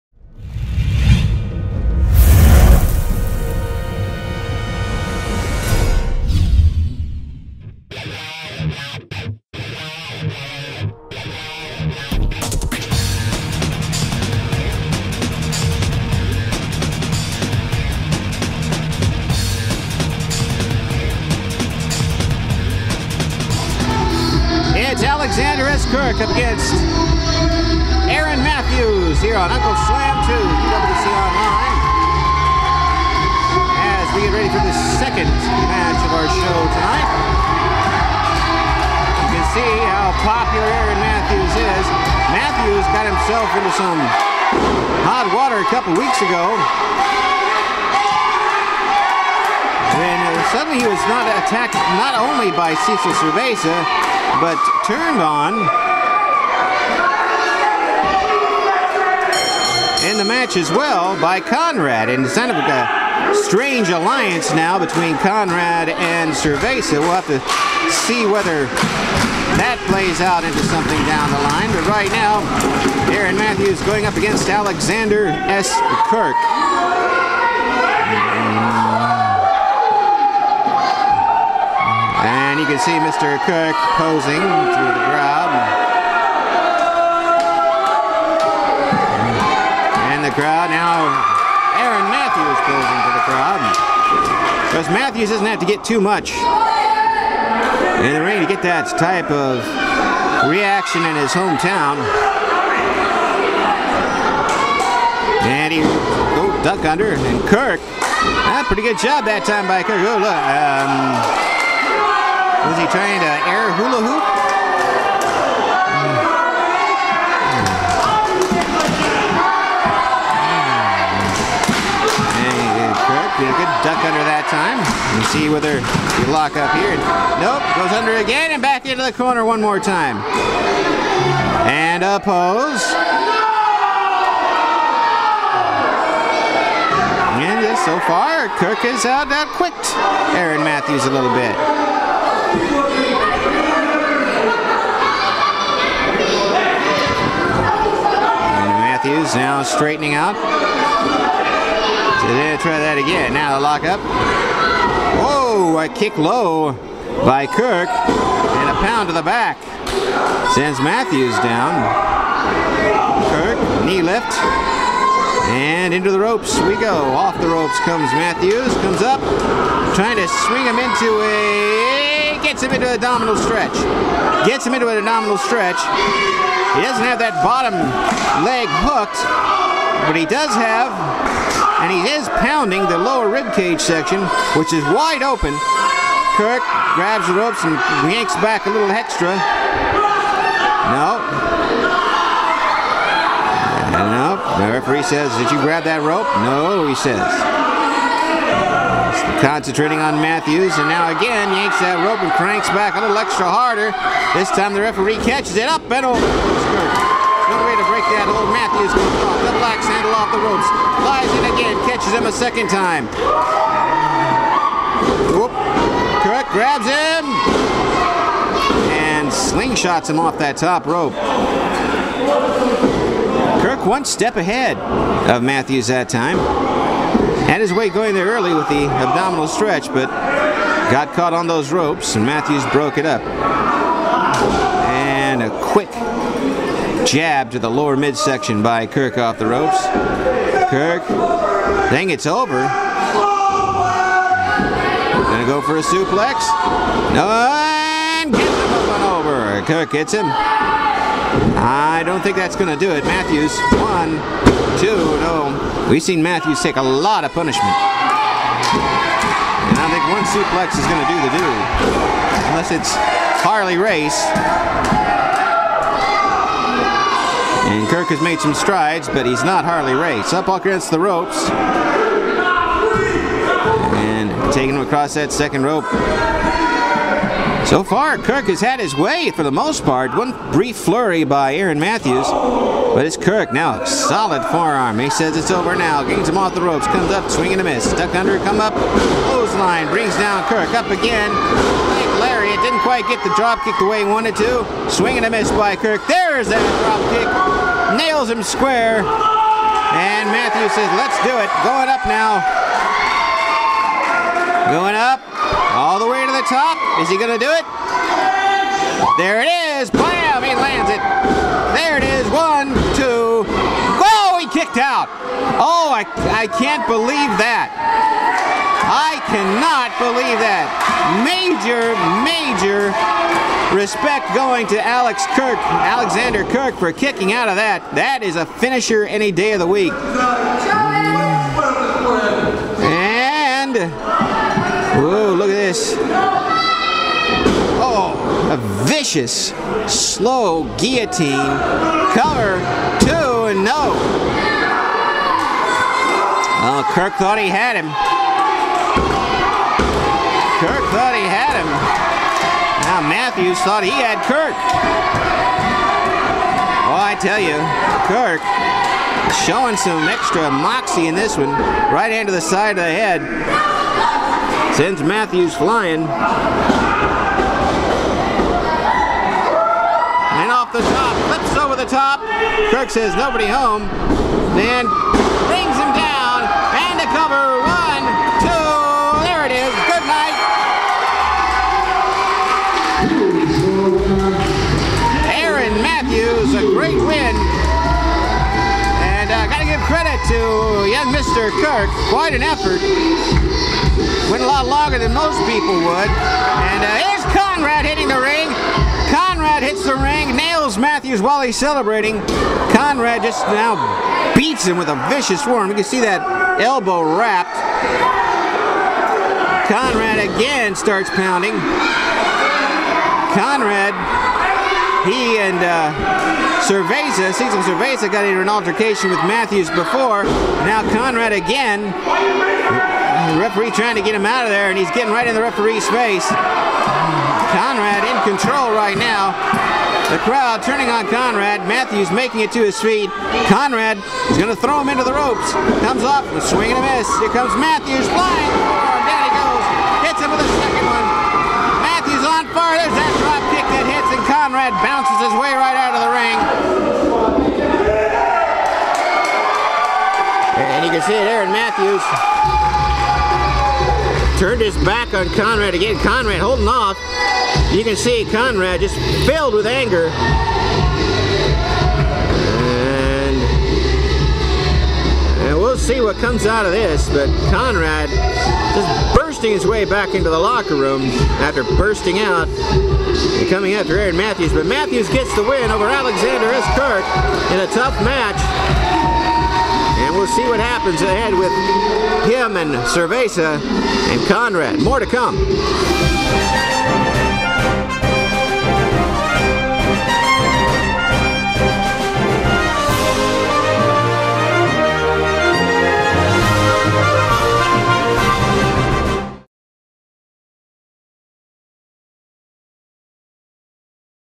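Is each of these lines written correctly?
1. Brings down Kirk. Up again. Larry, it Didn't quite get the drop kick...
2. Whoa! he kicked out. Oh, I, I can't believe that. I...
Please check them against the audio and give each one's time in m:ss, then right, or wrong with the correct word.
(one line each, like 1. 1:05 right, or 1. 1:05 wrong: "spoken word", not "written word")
1. 4:49 right
2. 5:13 right.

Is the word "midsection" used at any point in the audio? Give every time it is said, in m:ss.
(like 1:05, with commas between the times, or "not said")
3:57.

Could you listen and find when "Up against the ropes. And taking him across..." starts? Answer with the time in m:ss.
4:30.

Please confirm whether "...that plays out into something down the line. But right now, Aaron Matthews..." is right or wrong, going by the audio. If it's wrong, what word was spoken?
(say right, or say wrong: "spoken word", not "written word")
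right.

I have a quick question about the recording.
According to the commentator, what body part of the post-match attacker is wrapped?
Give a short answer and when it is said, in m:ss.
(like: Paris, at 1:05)
elbow, at 6:46.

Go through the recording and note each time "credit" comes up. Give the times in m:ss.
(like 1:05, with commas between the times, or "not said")
6:29.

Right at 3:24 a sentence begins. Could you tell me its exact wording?
This time the referee catches it up and over.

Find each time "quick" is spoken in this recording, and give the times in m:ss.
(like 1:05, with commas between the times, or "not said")
2:19, 3:55.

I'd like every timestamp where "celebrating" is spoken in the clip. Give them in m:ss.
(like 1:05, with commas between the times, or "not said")
6:41.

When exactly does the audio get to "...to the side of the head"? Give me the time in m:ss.
6:02.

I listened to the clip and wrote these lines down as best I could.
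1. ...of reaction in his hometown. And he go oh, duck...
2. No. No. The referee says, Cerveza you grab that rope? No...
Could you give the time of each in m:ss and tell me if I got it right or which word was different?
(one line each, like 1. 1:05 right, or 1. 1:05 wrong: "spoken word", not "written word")
1. 1:39 right
2. 3:10 wrong: "Did", not "Cerveza".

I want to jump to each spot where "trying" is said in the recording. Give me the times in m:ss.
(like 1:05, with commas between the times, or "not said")
1:52, 2:49, 7:03.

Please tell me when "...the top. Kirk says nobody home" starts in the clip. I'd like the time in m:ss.
6:11.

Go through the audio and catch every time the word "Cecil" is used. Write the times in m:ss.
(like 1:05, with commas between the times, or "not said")
0:52, 6:57.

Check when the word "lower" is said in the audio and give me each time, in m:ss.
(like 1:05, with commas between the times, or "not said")
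3:02, 3:57.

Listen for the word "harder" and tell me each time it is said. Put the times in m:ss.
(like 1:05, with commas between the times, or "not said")
3:23.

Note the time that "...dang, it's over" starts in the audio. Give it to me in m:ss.
4:01.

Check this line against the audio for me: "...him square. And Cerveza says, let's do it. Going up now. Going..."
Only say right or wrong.
wrong.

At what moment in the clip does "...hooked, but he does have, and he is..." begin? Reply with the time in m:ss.
2:58.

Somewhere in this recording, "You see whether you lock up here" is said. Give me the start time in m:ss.
2:05.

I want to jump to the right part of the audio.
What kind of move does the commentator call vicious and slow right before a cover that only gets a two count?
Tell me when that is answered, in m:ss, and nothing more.
5:40.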